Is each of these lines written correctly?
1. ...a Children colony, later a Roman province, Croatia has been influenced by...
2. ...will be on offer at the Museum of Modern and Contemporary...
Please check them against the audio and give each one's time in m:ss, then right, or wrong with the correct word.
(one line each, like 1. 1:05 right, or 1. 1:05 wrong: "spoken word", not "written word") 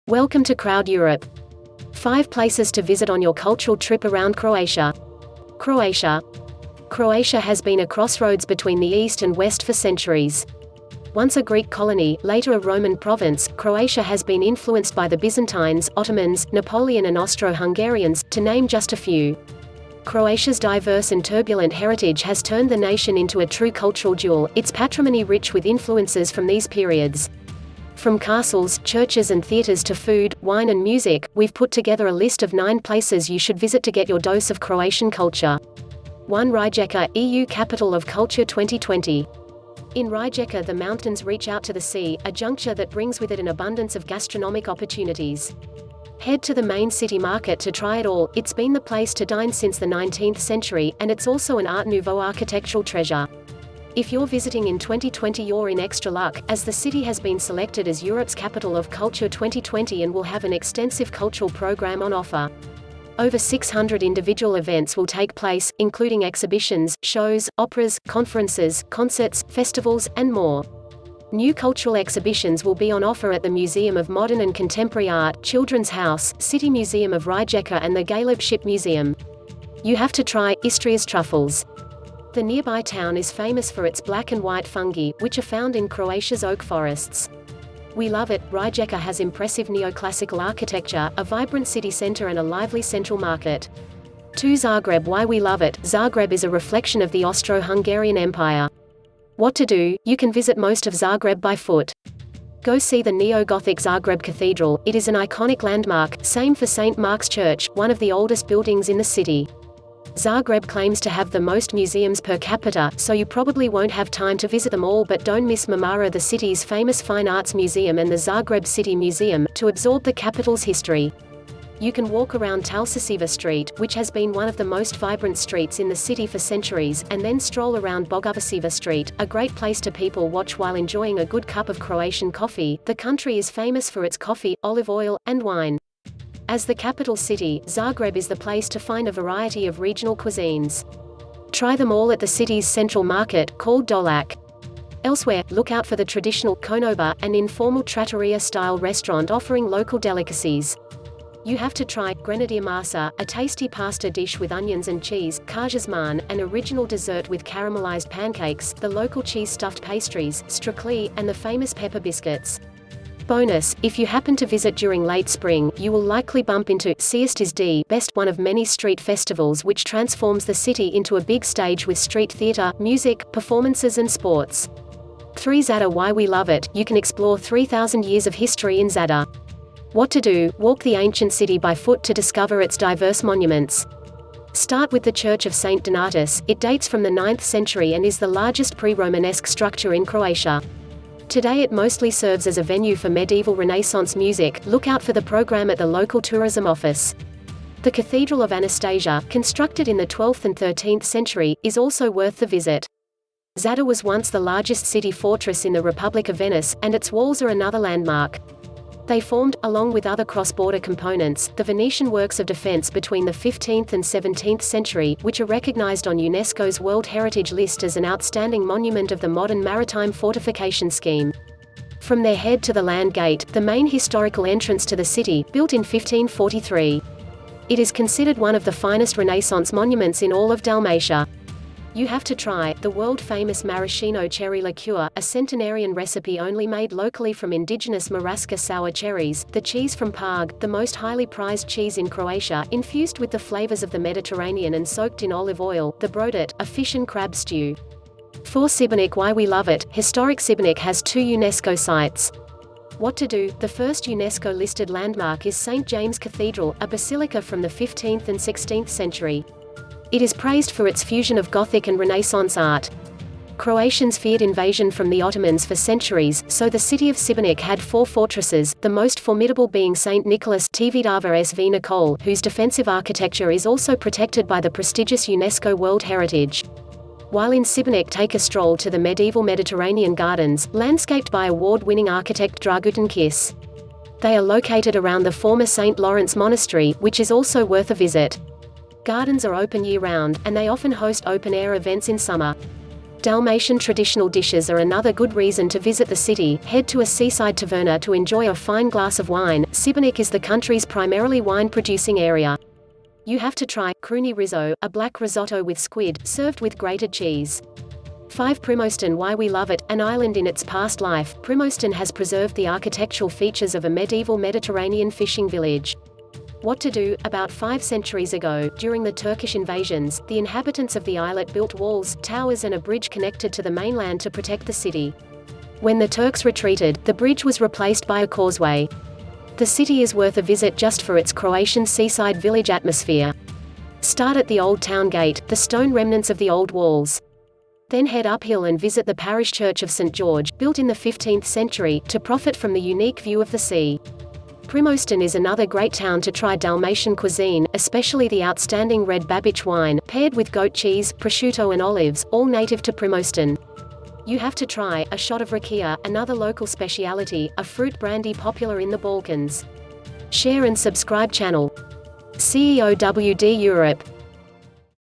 1. 0:11 wrong: "Greek", not "Children"
2. 1:12 right.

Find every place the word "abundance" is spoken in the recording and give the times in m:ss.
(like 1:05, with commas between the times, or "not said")
0:43.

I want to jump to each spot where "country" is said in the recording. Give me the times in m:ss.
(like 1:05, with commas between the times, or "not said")
2:12, 5:00.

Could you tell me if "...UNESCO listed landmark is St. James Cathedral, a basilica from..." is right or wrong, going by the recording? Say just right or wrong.
right.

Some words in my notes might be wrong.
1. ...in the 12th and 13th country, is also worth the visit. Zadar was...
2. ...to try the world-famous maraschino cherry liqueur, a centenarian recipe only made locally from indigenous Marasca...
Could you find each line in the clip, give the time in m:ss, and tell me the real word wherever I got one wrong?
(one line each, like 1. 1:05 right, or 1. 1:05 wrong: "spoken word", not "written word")
1. 3:19 wrong: "century", not "country"
2. 3:52 right.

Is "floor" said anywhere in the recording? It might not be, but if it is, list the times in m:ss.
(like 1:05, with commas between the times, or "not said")
not said.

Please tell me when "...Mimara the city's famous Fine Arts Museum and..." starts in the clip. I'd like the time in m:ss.
1:55.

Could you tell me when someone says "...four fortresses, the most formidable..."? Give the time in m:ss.
4:27.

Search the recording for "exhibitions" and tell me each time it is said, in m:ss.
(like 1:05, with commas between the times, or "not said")
1:06, 1:11.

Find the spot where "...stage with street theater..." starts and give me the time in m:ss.
2:51.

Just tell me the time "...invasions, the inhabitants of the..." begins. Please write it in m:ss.
5:19.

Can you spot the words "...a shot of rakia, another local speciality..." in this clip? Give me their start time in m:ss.
5:55.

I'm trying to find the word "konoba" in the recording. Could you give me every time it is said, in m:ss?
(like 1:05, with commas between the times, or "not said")
2:26.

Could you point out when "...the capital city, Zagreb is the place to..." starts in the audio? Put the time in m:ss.
2:16.